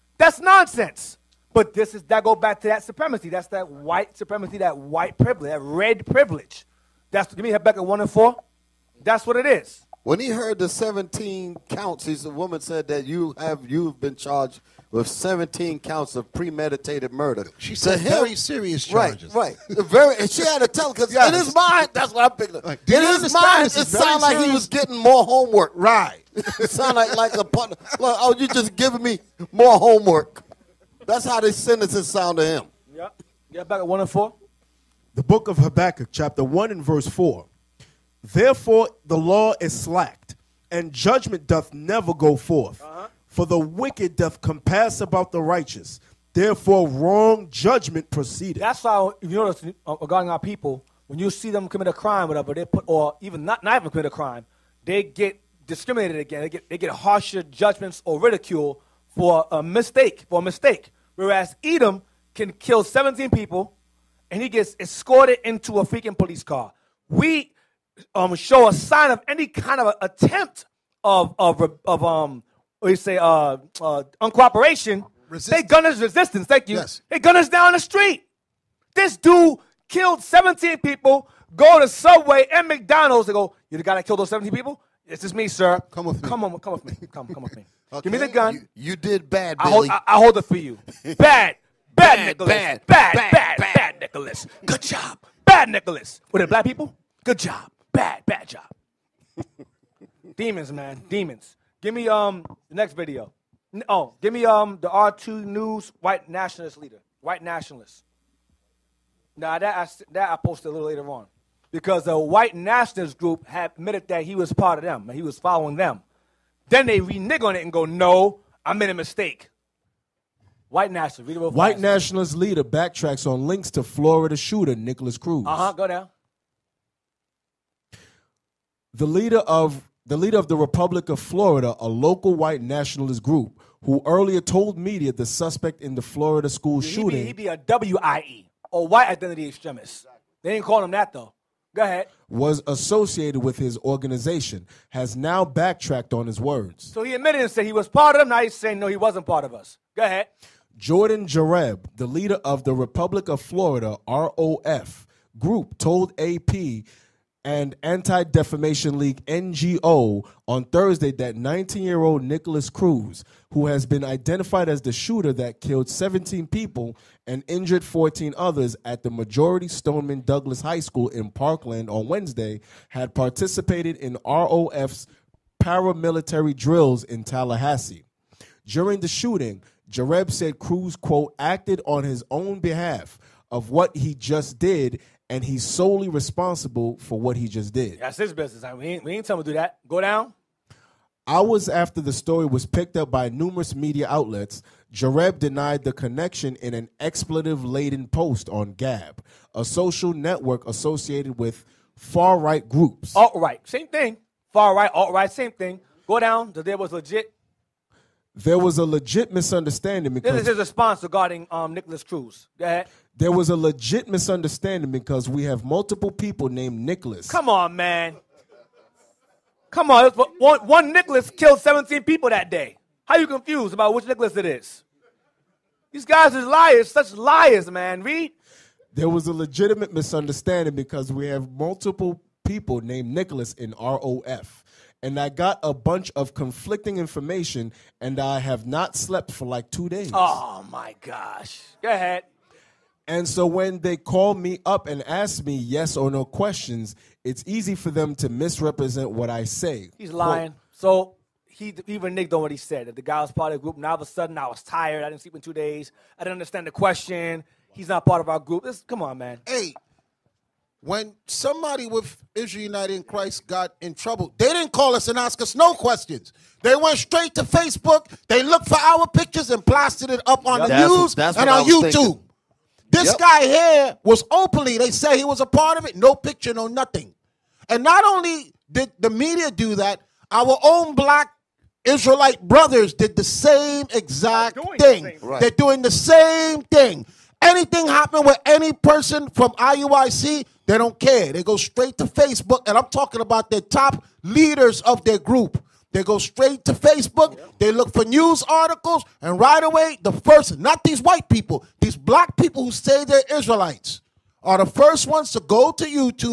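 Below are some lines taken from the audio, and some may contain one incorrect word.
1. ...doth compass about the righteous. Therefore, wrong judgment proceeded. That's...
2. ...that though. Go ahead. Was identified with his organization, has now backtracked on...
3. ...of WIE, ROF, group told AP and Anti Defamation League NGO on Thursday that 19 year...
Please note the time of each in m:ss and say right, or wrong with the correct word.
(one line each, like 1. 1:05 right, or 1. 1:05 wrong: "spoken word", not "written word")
1. 0:44 right
2. 2:20 wrong: "associated", not "identified"
3. 2:33 wrong: "Florida", not "WIE".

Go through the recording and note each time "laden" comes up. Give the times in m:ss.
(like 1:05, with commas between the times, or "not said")
3:17.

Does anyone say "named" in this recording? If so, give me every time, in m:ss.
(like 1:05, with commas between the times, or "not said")
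3:36, 3:52.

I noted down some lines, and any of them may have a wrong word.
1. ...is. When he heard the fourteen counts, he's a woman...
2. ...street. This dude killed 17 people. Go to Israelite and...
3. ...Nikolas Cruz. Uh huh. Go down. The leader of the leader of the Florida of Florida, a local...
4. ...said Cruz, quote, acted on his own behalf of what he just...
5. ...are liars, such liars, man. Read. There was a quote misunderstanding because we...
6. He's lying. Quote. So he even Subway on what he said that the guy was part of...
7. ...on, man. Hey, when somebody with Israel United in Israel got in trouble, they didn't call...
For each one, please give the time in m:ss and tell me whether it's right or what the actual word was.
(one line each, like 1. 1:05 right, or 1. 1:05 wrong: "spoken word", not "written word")
1. 0:09 wrong: "seventeen", not "fourteen"
2. 1:17 wrong: "Subway", not "Israelite"
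3. 2:04 wrong: "Republic", not "Florida"
4. 3:00 right
5. 3:46 wrong: "legitimate", not "quote"
6. 4:09 wrong: "Nick", not "Subway"
7. 4:19 wrong: "Christ", not "Israel".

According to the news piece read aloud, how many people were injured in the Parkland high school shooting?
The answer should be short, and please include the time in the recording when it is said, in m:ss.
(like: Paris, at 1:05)
14, at 2:47.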